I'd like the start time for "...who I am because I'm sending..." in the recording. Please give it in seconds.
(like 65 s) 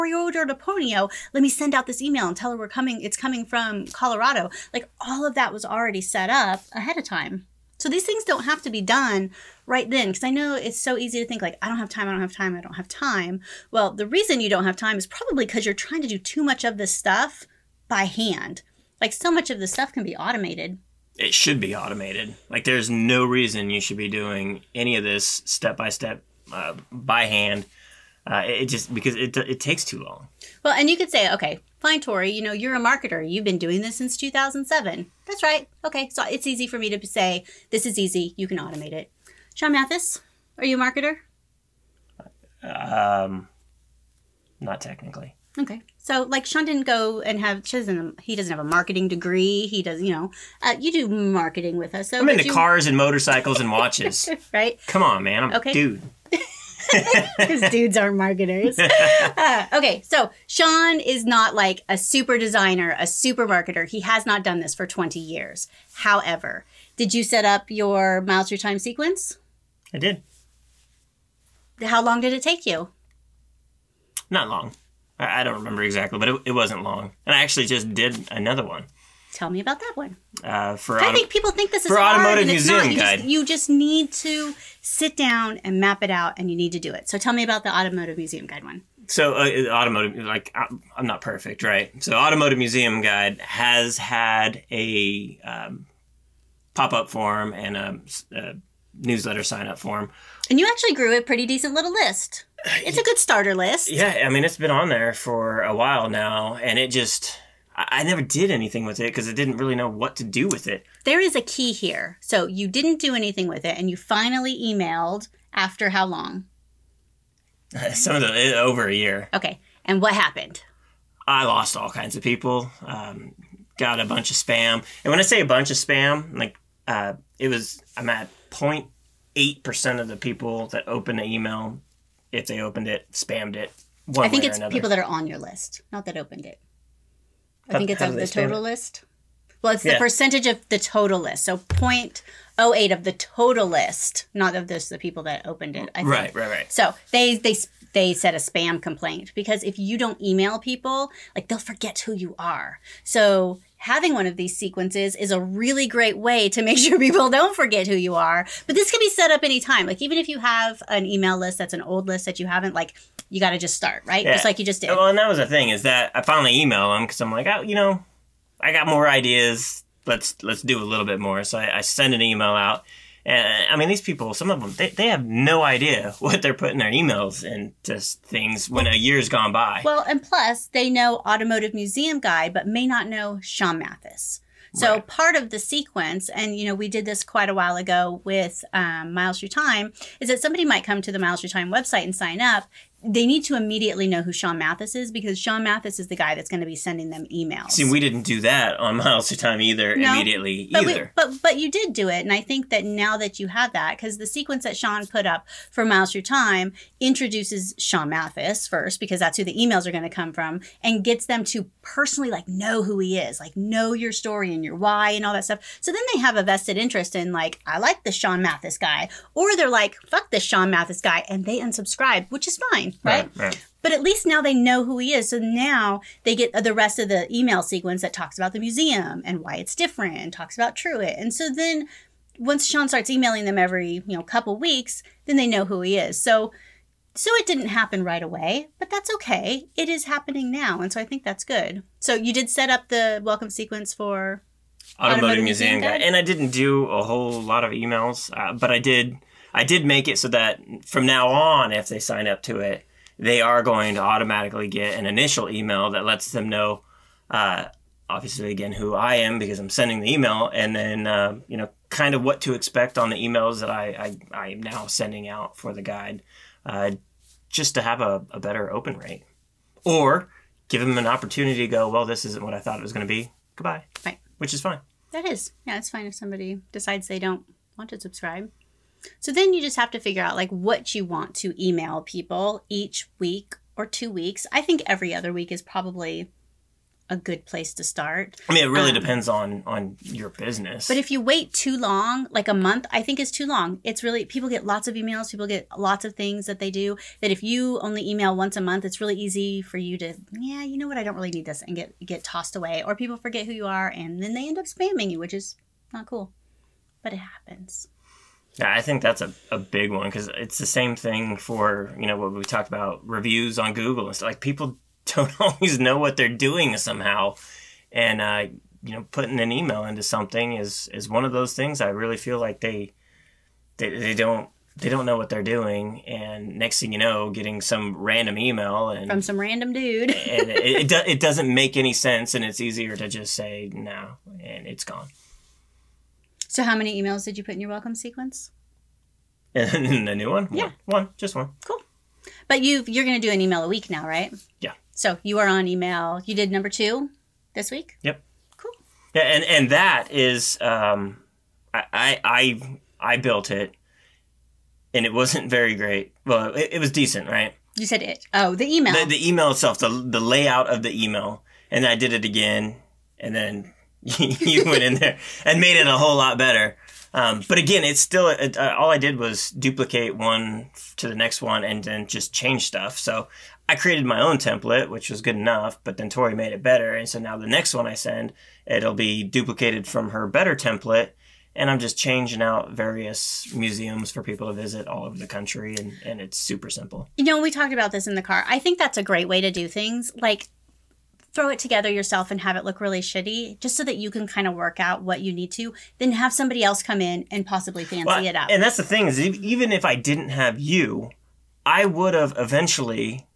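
258 s.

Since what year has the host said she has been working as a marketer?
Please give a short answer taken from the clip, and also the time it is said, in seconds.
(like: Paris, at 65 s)
2007, at 34 s.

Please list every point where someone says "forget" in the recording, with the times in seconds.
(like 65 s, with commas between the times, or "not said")
151 s, 157 s, 303 s.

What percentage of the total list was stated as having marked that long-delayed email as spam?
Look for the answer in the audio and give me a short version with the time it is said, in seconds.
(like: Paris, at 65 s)
0.08%, at 141 s.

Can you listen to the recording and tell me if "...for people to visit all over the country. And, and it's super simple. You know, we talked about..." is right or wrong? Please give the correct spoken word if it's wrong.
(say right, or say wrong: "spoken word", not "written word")
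right.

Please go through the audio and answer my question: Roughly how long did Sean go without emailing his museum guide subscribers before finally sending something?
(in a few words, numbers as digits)
Over a year.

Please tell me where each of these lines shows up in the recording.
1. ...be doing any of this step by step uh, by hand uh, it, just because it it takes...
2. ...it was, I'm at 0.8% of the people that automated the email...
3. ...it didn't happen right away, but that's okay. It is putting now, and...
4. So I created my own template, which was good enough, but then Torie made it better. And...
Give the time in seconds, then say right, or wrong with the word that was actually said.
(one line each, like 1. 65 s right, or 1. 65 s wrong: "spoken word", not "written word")
1. 23 s right
2. 127 s wrong: "opened", not "automated"
3. 237 s wrong: "happening", not "putting"
4. 372 s right.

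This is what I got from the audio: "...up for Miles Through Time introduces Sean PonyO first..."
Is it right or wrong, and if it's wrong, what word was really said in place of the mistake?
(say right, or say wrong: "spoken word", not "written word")
wrong: "Mathis", not "PonyO".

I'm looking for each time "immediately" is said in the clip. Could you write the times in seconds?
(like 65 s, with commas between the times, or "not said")
193 s, 200 s.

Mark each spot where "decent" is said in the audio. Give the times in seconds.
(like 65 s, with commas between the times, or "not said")
101 s, 356 s.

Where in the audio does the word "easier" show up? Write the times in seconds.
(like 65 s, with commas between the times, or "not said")
332 s.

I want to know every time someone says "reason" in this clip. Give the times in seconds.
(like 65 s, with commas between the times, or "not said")
14 s, 23 s.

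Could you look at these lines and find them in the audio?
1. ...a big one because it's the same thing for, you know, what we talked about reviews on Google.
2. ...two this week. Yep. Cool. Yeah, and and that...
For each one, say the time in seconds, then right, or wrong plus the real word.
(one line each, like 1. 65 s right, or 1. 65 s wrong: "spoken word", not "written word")
1. 309 s right
2. 346 s right.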